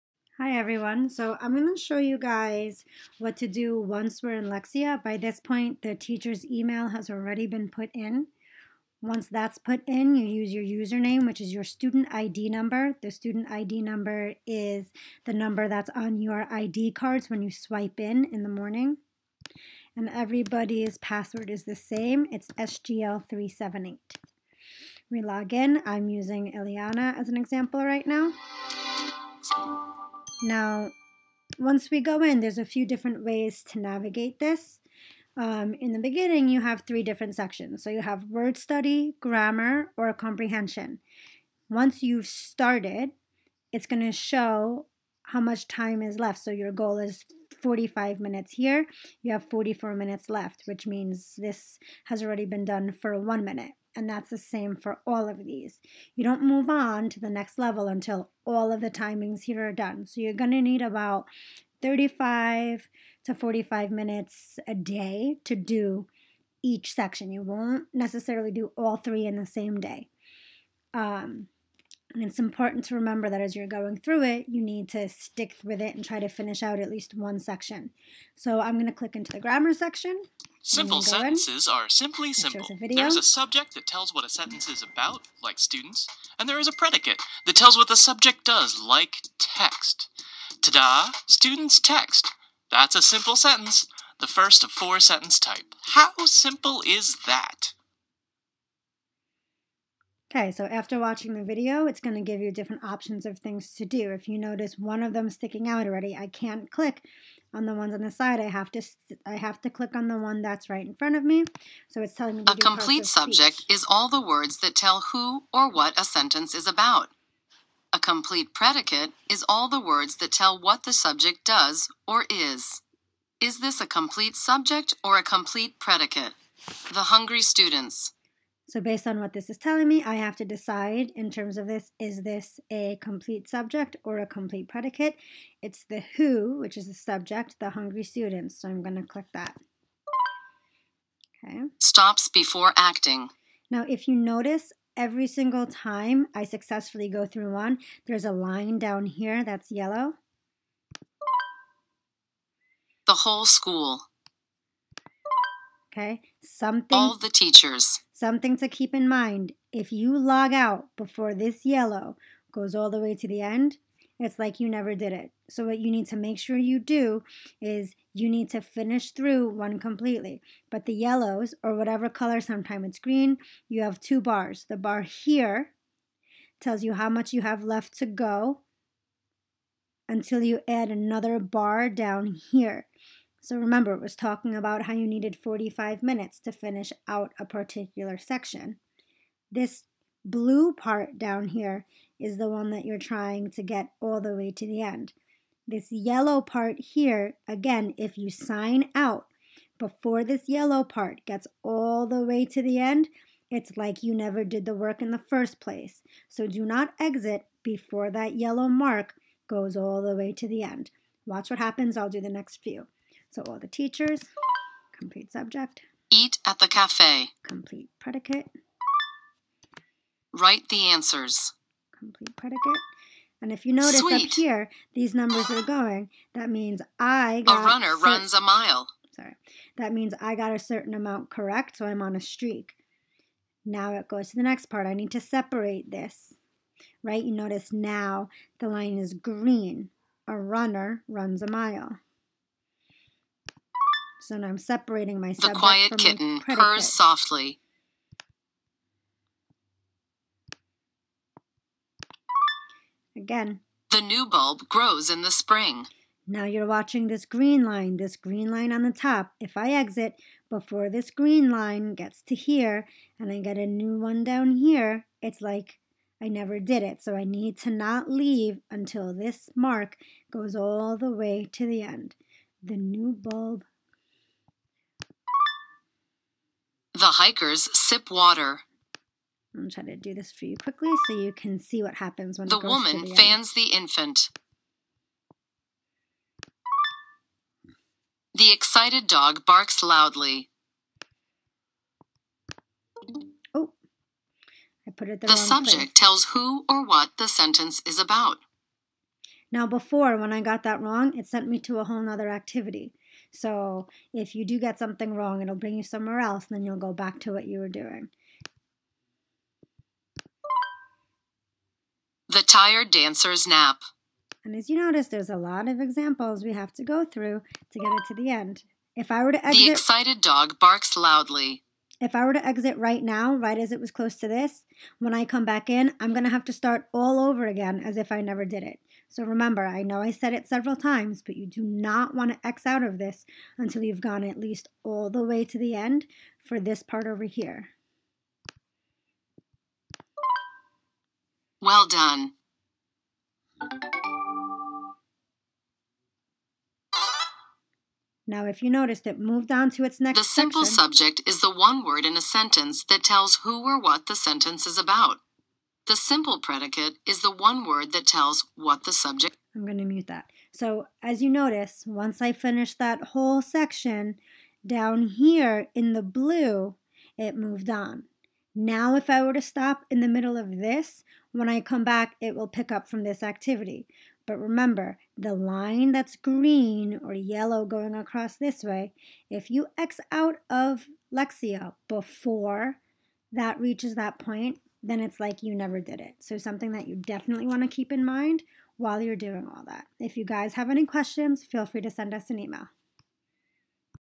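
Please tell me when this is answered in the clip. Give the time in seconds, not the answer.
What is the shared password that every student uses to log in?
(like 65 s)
22 s.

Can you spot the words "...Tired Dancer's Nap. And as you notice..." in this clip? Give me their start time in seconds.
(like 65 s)
312 s.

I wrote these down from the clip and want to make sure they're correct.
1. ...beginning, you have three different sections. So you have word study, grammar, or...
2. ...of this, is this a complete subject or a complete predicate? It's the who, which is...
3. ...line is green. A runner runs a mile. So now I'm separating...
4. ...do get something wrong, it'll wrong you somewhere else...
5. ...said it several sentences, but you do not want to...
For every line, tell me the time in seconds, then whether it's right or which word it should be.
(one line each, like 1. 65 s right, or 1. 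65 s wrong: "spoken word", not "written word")
1. 35 s right
2. 131 s right
3. 238 s right
4. 304 s wrong: "bring", not "wrong"
5. 330 s wrong: "times", not "sentences".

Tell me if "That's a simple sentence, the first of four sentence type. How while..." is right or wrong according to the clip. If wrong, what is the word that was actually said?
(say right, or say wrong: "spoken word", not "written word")
wrong: "simple", not "while".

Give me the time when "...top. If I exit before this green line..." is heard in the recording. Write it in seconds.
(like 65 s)
258 s.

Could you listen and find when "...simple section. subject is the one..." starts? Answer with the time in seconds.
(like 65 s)
350 s.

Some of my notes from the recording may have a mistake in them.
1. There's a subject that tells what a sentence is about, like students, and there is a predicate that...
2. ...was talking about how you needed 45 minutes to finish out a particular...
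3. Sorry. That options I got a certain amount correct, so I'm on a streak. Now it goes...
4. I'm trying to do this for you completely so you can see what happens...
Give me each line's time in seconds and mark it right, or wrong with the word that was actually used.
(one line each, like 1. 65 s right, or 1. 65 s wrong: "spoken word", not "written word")
1. 82 s right
2. 184 s right
3. 229 s wrong: "means", not "options"
4. 279 s wrong: "quickly", not "completely".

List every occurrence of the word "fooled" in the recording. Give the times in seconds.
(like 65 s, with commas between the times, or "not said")
not said.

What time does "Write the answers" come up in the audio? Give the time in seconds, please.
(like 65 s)
220 s.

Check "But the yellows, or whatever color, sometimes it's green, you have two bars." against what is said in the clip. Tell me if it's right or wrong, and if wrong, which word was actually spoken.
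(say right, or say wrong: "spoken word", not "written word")
right.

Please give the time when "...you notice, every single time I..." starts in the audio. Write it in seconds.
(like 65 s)
144 s.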